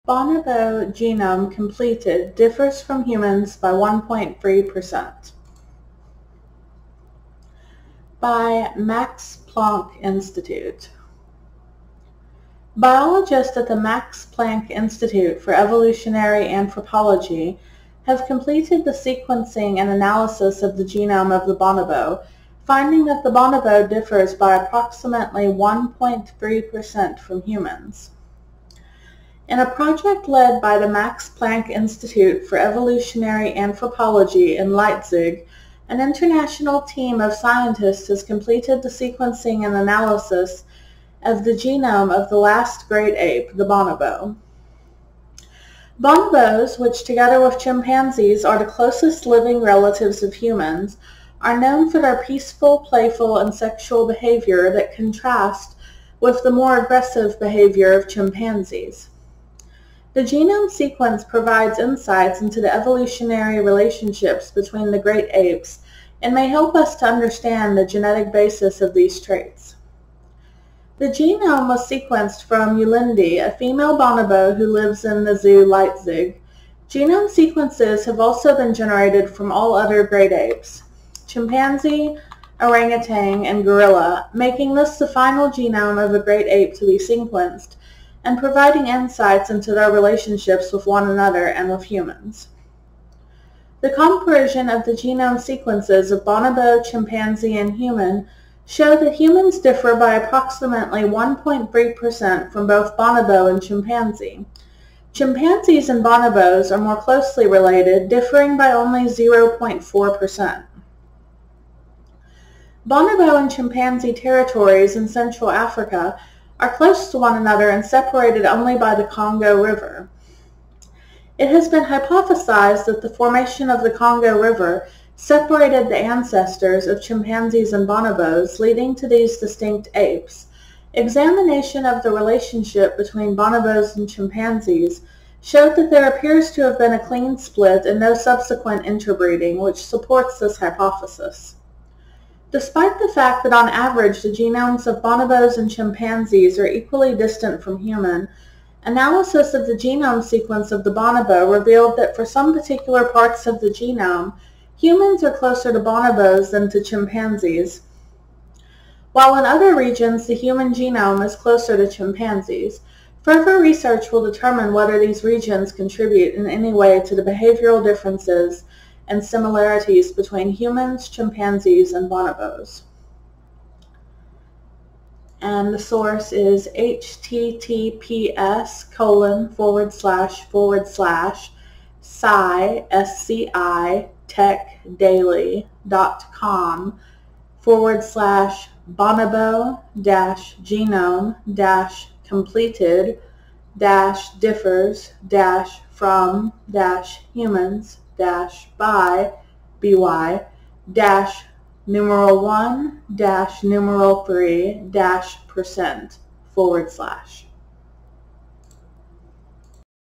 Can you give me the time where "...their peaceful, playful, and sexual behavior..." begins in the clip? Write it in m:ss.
0:51.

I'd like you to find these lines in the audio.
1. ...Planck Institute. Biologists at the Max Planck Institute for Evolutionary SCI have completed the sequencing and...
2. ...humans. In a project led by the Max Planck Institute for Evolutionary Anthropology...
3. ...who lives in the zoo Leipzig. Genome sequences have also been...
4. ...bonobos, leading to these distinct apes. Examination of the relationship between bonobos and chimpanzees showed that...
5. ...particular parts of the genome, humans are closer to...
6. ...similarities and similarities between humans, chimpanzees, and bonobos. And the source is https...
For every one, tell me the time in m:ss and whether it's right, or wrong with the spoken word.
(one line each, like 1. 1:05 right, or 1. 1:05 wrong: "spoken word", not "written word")
1. 0:09 wrong: "Anthropology", not "SCI"
2. 0:27 right
3. 1:14 right
4. 2:07 right
5. 2:32 right
6. 2:47 wrong: "differences", not "similarities".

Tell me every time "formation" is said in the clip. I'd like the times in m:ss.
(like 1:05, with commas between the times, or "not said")
2:03.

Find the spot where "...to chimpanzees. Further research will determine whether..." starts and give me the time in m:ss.
2:41.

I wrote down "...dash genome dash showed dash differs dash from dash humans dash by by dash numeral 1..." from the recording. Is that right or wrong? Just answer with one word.
wrong.